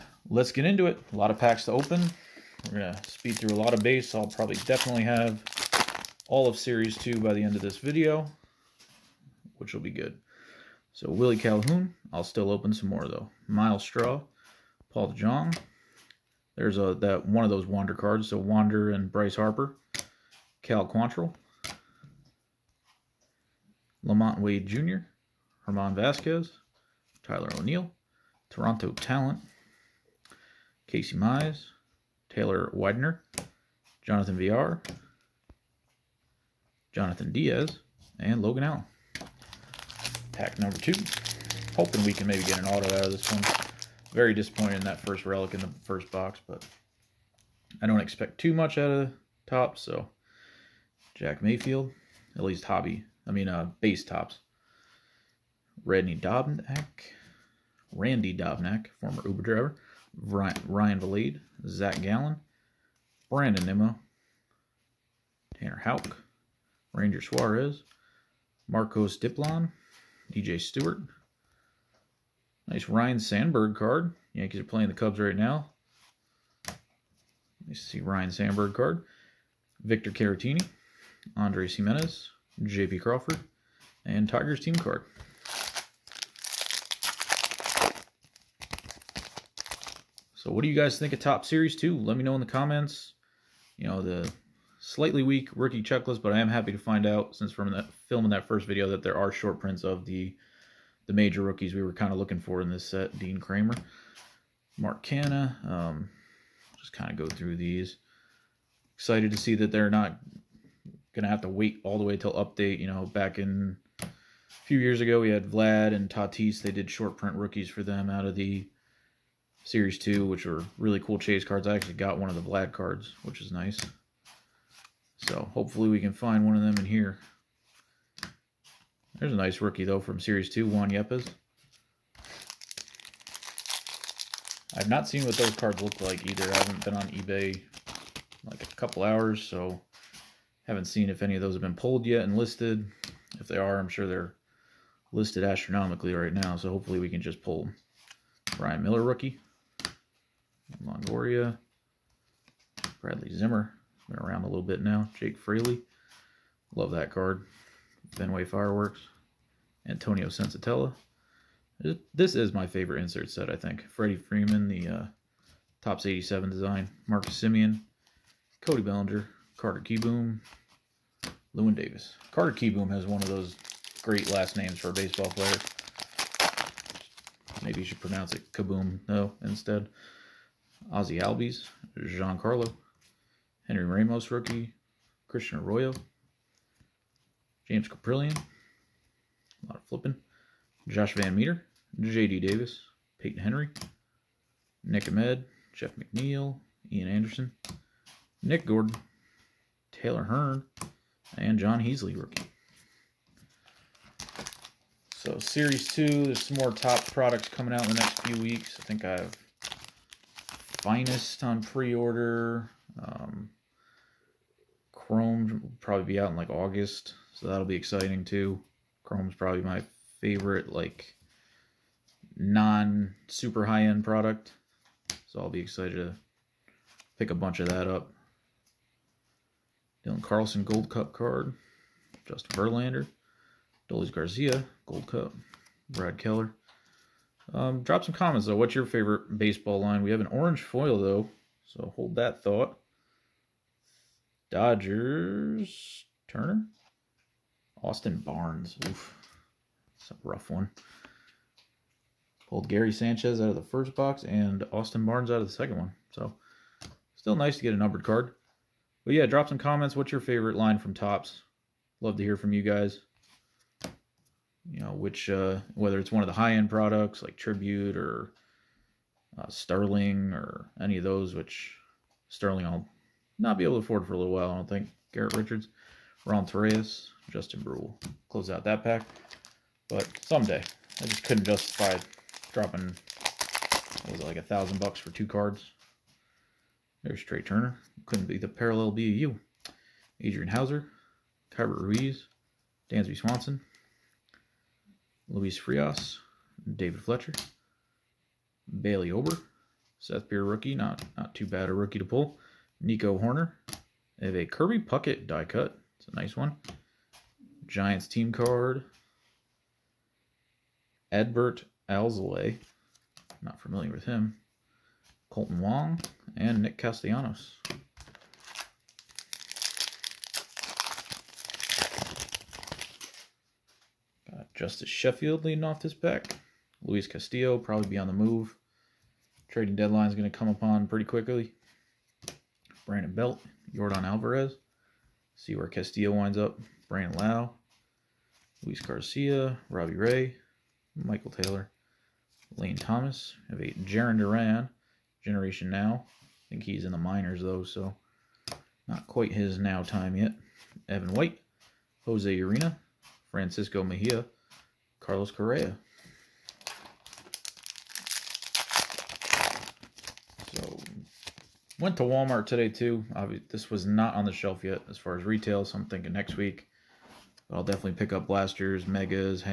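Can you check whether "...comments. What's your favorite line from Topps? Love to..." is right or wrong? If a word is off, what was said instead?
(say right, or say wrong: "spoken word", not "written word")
right.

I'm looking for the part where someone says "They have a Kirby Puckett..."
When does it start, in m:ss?
5:04.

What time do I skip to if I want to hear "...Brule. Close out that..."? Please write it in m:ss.
4:37.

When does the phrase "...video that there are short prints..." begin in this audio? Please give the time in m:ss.
1:38.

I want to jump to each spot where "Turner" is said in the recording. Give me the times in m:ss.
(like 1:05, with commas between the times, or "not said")
4:06, 4:47.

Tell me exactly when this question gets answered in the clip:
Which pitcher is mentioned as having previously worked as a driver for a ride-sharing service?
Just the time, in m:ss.
0:57.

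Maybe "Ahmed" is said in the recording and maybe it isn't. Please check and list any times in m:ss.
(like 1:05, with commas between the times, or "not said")
3:15.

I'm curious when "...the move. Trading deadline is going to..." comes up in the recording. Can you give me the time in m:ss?
5:28.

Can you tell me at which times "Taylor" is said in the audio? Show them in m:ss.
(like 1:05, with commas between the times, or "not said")
0:32, 3:19, 5:41.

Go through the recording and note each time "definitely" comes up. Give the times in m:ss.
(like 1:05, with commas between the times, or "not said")
0:04, 6:07.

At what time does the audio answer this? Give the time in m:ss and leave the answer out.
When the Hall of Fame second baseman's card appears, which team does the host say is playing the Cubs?
1:14.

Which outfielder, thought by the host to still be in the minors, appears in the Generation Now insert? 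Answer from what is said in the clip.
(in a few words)
Jarren Duran.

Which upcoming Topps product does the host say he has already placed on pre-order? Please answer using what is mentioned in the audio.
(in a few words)
Finest.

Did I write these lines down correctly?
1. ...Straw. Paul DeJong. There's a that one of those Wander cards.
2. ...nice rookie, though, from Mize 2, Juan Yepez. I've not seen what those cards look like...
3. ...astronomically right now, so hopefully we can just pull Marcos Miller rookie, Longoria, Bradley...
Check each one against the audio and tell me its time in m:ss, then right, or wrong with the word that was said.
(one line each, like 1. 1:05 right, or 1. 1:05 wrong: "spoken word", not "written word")
1. 0:13 right
2. 2:09 wrong: "Series", not "Mize"
3. 2:25 wrong: "Brian", not "Marcos".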